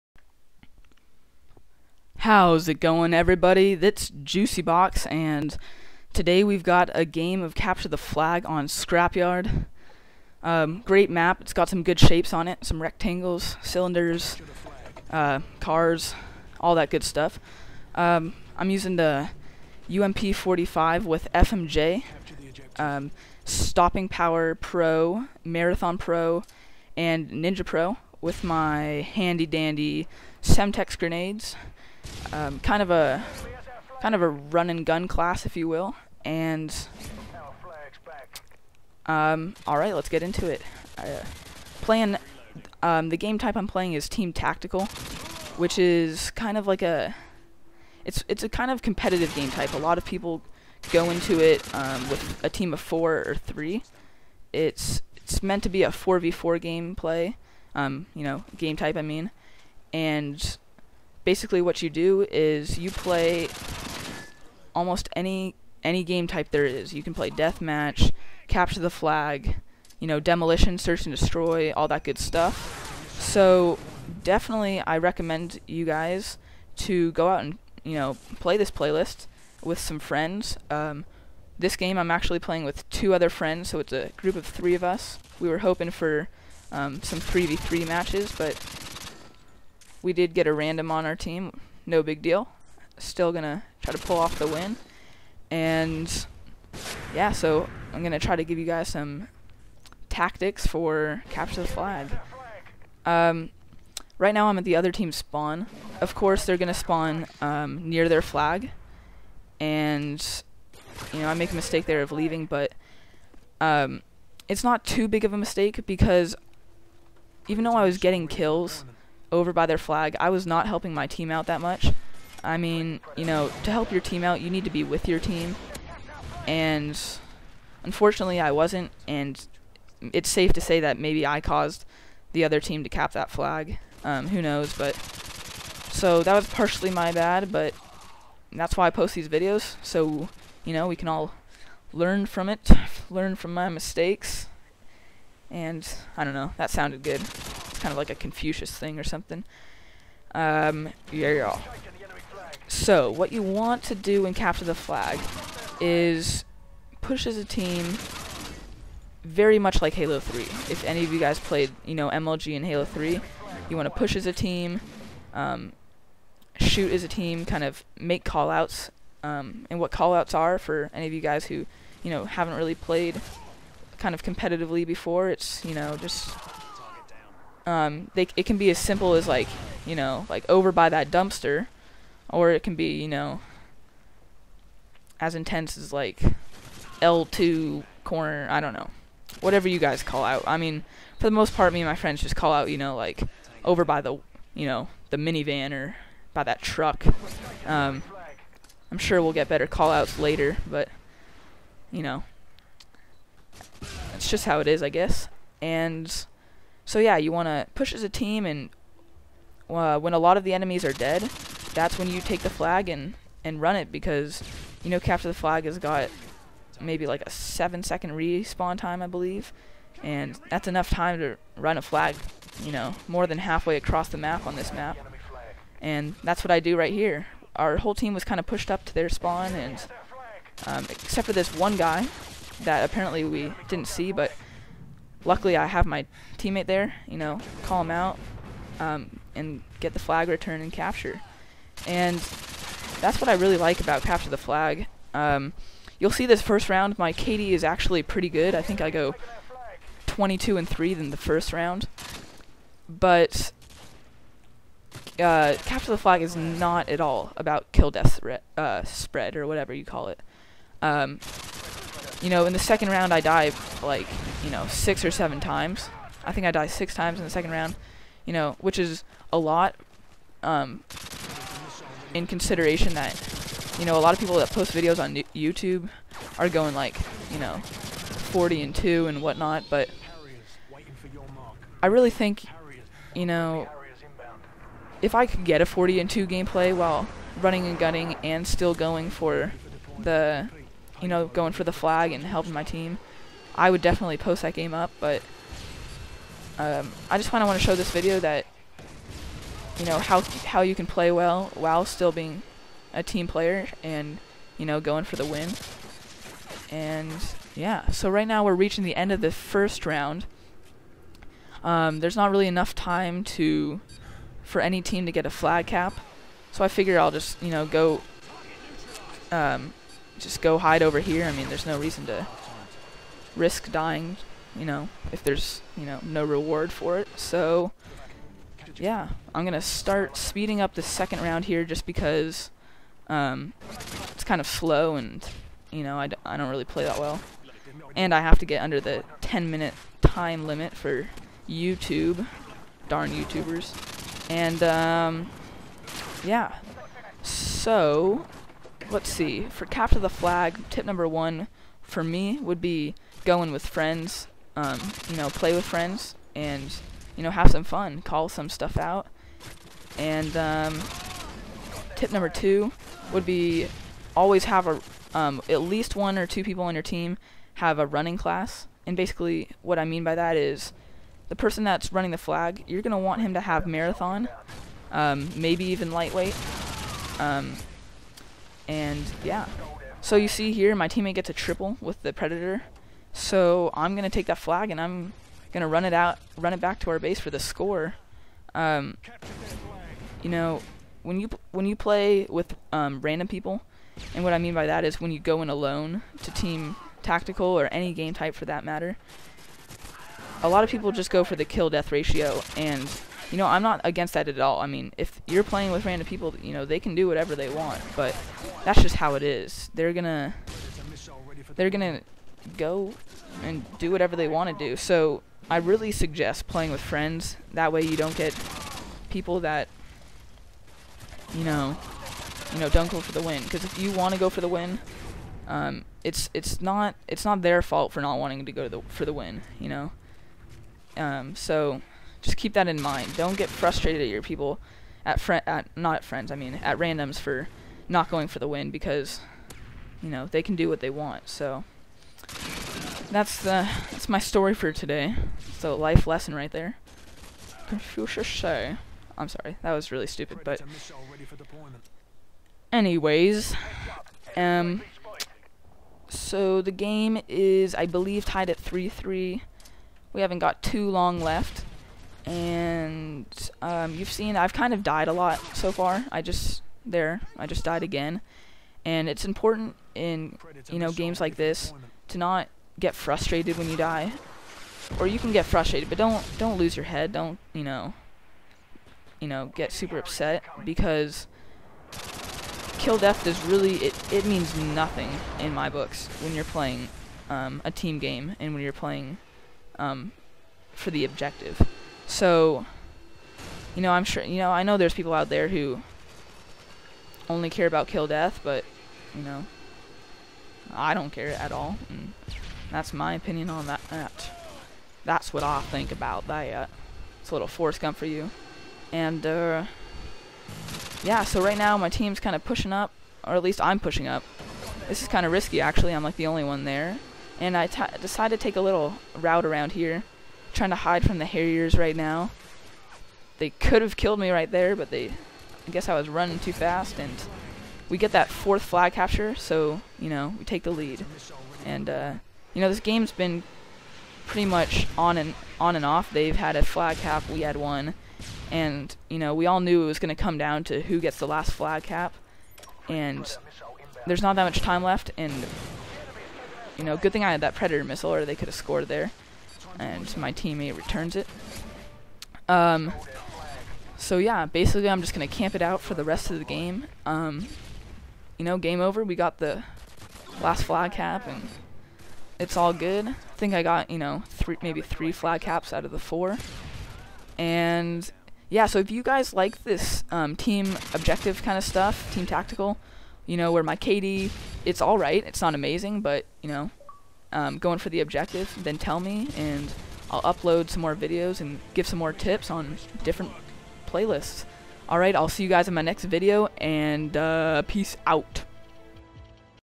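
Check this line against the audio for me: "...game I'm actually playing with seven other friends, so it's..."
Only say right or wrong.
wrong.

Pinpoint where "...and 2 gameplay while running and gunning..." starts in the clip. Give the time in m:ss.
4:45.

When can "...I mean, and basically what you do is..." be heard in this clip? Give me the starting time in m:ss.
0:58.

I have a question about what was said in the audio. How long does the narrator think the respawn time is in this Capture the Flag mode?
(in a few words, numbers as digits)
7 seconds.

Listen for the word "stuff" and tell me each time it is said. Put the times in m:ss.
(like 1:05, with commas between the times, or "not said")
0:17, 1:12, 5:58, 9:31.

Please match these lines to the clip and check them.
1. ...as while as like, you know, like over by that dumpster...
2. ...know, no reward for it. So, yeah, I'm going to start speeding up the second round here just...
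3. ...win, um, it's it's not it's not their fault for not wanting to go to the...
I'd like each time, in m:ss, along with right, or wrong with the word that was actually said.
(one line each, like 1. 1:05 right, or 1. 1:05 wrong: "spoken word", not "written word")
1. 2:58 wrong: "simple", not "while"
2. 5:25 right
3. 7:04 right.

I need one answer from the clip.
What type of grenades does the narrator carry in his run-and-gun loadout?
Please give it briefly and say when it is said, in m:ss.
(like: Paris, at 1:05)
Semtex, at 0:30.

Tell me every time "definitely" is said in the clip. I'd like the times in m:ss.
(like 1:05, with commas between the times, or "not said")
1:14, 4:53.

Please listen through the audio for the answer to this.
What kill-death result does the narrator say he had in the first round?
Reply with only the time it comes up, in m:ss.
4:10.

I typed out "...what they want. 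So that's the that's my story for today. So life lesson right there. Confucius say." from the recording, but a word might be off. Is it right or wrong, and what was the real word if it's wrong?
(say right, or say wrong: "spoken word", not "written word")
right.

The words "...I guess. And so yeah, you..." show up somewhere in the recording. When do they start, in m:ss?
3:24.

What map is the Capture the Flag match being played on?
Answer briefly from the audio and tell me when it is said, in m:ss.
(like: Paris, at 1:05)
Scrapyard, at 0:08.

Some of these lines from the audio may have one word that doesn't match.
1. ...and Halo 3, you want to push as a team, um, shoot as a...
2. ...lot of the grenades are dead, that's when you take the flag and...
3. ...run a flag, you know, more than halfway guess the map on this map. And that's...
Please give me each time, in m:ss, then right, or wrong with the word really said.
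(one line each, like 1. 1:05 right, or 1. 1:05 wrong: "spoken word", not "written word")
1. 2:42 right
2. 3:30 wrong: "enemies", not "grenades"
3. 3:41 wrong: "across", not "guess".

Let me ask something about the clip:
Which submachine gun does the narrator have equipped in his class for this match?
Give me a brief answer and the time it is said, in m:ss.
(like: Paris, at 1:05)
UMP45, at 0:19.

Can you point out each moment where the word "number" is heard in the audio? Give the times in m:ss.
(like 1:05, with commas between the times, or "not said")
5:50, 6:02.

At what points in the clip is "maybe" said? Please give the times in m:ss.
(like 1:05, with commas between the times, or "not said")
2:10, 3:36, 6:15, 9:24.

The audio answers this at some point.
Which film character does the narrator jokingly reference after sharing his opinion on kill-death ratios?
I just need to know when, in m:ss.
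8:27.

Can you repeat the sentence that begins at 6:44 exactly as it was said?
I mean, if you're playing with random people, you know, they can do whatever they want, but that's just how it is.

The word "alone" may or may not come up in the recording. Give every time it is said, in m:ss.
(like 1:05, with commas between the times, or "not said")
6:35.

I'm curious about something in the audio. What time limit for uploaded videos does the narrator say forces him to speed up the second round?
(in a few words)
10 minutes.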